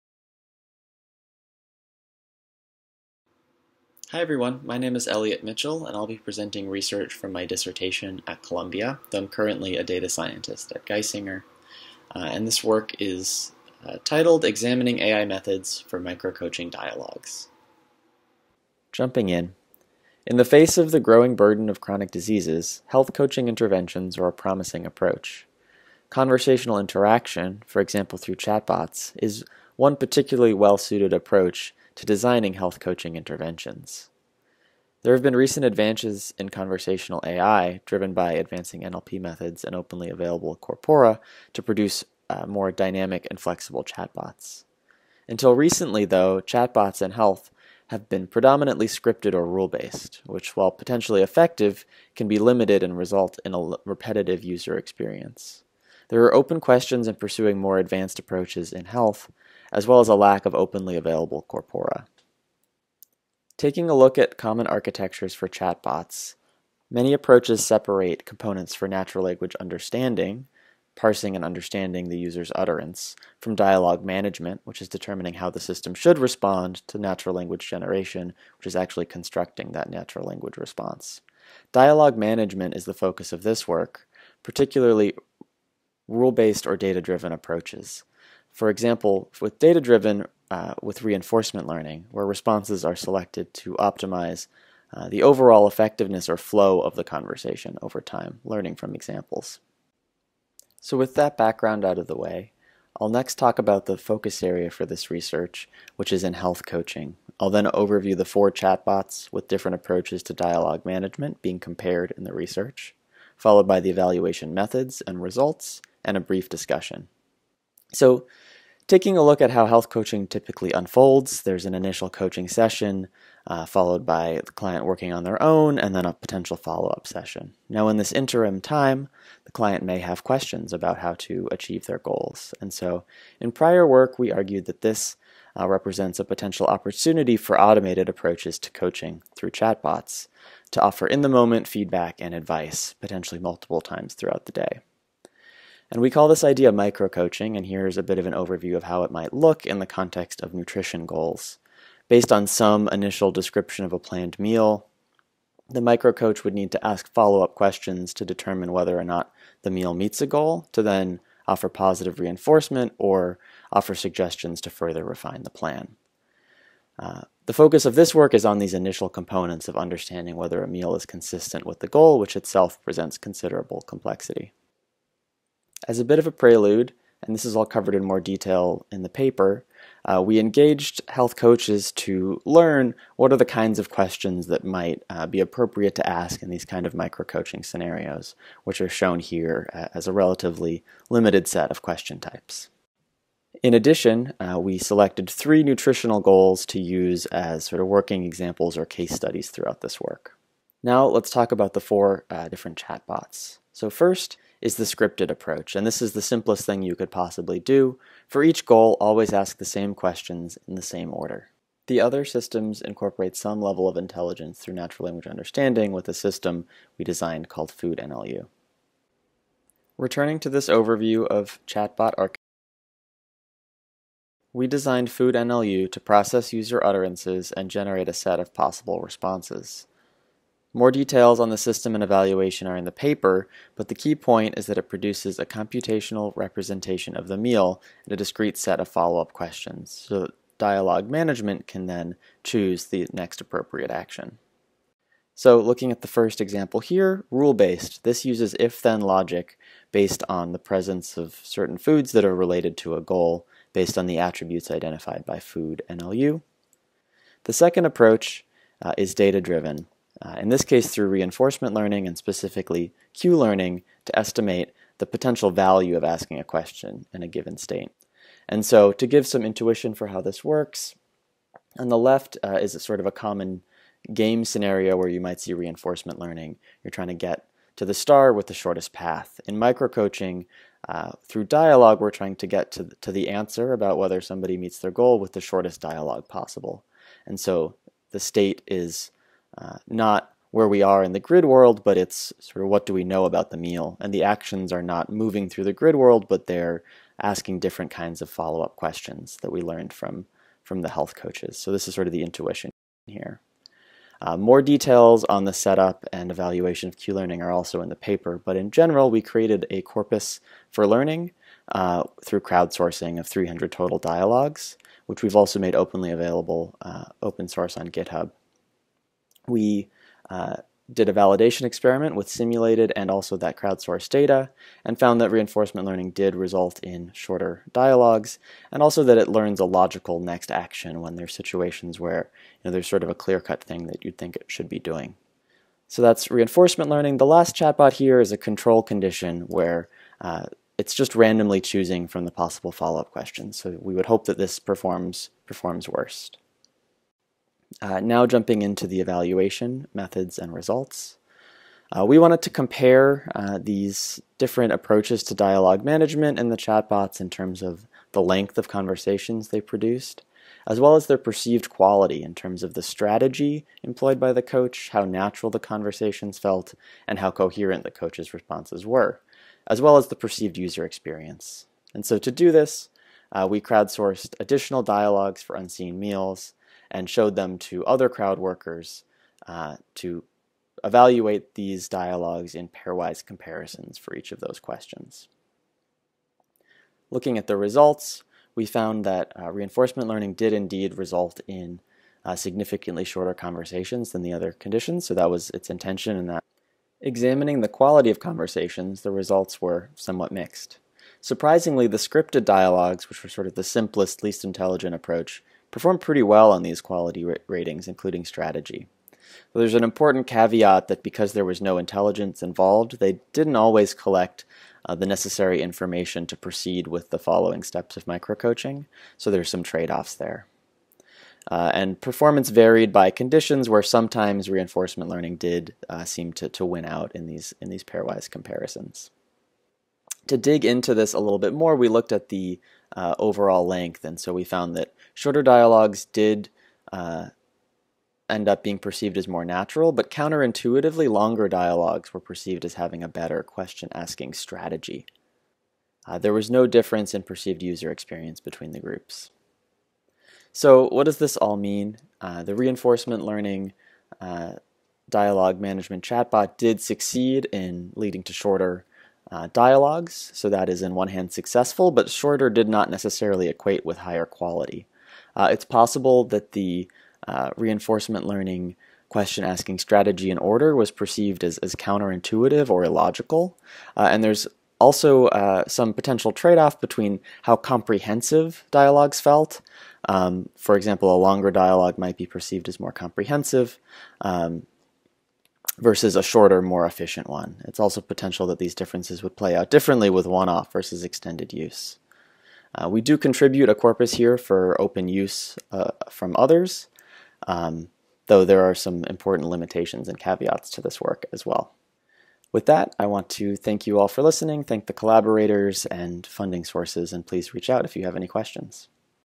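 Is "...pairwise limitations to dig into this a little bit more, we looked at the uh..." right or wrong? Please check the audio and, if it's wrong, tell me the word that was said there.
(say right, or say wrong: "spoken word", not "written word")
wrong: "comparisons", not "limitations".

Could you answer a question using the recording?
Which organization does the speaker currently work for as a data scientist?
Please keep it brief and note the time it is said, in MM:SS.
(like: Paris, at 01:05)
Geisinger, at 00:10.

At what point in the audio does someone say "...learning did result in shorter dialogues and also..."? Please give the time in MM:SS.
05:25.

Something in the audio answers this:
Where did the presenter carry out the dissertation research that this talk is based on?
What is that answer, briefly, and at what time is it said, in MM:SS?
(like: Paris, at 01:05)
Columbia, at 00:08.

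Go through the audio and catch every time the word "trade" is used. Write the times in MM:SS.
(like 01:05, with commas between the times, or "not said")
06:59, 07:56.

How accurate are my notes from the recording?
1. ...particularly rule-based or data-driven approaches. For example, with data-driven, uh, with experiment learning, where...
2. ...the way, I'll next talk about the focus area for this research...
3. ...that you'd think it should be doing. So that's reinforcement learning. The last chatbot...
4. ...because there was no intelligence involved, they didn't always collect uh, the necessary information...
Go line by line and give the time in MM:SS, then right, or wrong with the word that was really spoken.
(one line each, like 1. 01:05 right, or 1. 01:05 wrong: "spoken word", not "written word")
1. 01:24 wrong: "reinforcement", not "experiment"
2. 01:42 right
3. 05:33 right
4. 06:51 right.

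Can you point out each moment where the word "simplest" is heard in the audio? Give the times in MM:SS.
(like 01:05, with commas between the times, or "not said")
03:26, 06:43.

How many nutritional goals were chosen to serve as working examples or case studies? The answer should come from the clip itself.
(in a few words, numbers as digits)
3.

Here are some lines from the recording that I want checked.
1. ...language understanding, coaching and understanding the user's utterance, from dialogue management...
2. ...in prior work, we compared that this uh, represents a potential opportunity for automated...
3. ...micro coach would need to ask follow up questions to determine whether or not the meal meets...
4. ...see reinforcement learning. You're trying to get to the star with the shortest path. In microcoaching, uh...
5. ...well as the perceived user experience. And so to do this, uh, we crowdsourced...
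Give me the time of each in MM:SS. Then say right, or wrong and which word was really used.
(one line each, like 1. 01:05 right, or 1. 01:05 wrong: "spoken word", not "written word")
1. 01:09 wrong: "parsing", not "coaching"
2. 02:13 wrong: "argued", not "compared"
3. 02:35 right
4. 04:35 right
5. 06:09 right.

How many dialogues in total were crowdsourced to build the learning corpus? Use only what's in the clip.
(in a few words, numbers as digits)
300.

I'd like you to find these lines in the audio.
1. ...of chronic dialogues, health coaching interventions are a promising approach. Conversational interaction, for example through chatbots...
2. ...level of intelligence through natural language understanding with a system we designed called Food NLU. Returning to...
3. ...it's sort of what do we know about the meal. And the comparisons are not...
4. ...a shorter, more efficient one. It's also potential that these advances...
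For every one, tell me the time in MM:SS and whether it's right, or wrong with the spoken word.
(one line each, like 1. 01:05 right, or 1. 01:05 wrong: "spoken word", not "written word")
1. 00:21 wrong: "diseases", not "dialogues"
2. 03:33 right
3. 04:51 wrong: "actions", not "comparisons"
4. 08:06 wrong: "differences", not "advances".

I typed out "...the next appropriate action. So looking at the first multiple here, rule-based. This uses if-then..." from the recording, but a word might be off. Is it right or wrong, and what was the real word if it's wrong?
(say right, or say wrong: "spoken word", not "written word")
wrong: "example", not "multiple".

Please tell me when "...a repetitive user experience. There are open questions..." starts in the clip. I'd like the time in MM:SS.
00:53.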